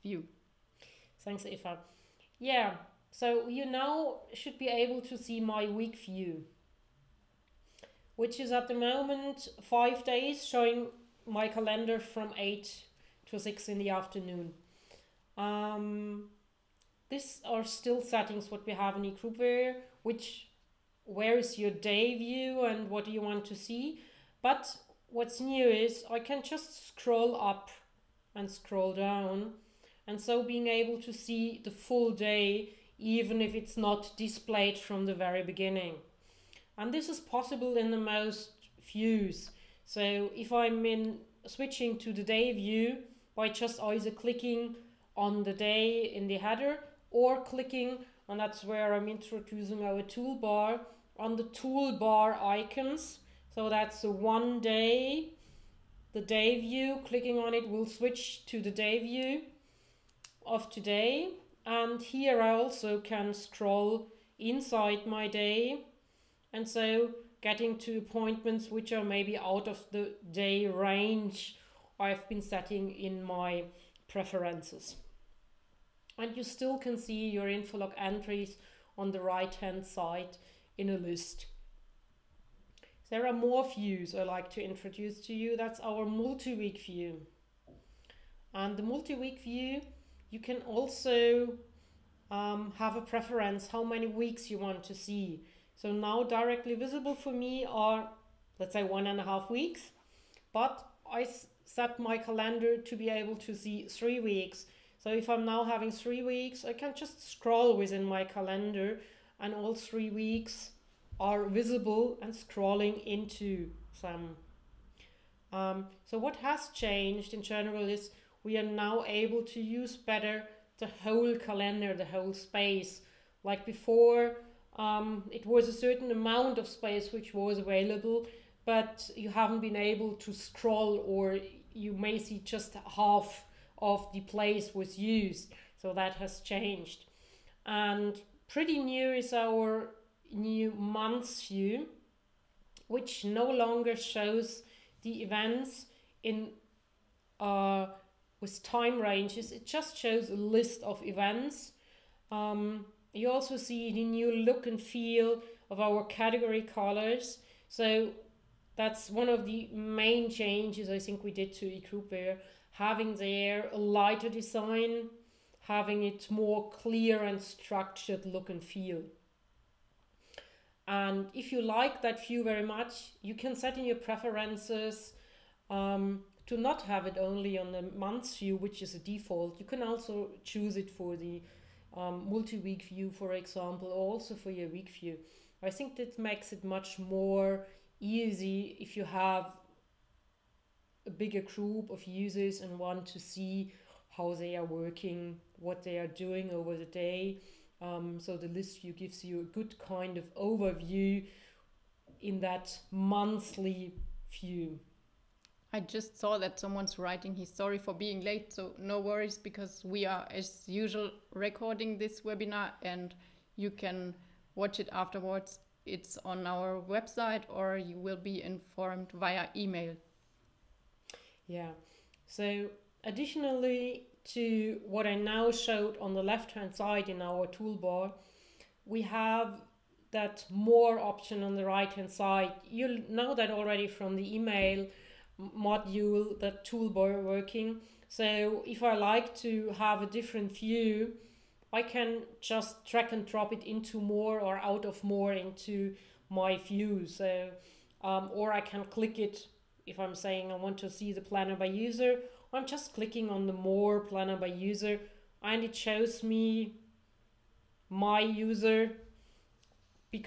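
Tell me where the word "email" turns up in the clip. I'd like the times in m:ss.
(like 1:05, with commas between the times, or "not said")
3:39, 3:54.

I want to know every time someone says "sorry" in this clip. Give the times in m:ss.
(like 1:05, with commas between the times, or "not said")
3:27.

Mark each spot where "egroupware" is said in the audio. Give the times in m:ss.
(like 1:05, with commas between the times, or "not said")
0:19, 2:41.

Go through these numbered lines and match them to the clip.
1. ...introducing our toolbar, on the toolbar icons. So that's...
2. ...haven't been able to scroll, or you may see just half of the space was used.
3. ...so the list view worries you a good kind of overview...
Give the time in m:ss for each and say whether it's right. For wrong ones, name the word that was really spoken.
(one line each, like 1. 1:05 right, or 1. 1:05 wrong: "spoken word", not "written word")
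1. 0:49 right
2. 2:09 wrong: "place", not "space"
3. 3:18 wrong: "gives", not "worries".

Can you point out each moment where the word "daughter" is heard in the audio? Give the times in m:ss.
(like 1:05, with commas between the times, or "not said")
not said.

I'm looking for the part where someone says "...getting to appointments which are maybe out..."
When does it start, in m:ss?
1:07.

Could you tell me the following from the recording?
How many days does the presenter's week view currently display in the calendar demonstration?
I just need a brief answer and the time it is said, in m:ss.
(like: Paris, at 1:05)
5, at 0:09.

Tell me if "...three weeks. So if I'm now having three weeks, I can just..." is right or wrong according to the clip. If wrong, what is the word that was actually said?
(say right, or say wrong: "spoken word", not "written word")
right.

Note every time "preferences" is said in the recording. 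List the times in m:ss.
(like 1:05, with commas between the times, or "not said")
1:14, 1:33, 2:53.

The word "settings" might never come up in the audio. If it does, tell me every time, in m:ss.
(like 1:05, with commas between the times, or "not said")
0:18, 1:12.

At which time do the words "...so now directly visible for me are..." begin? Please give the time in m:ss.
1:35.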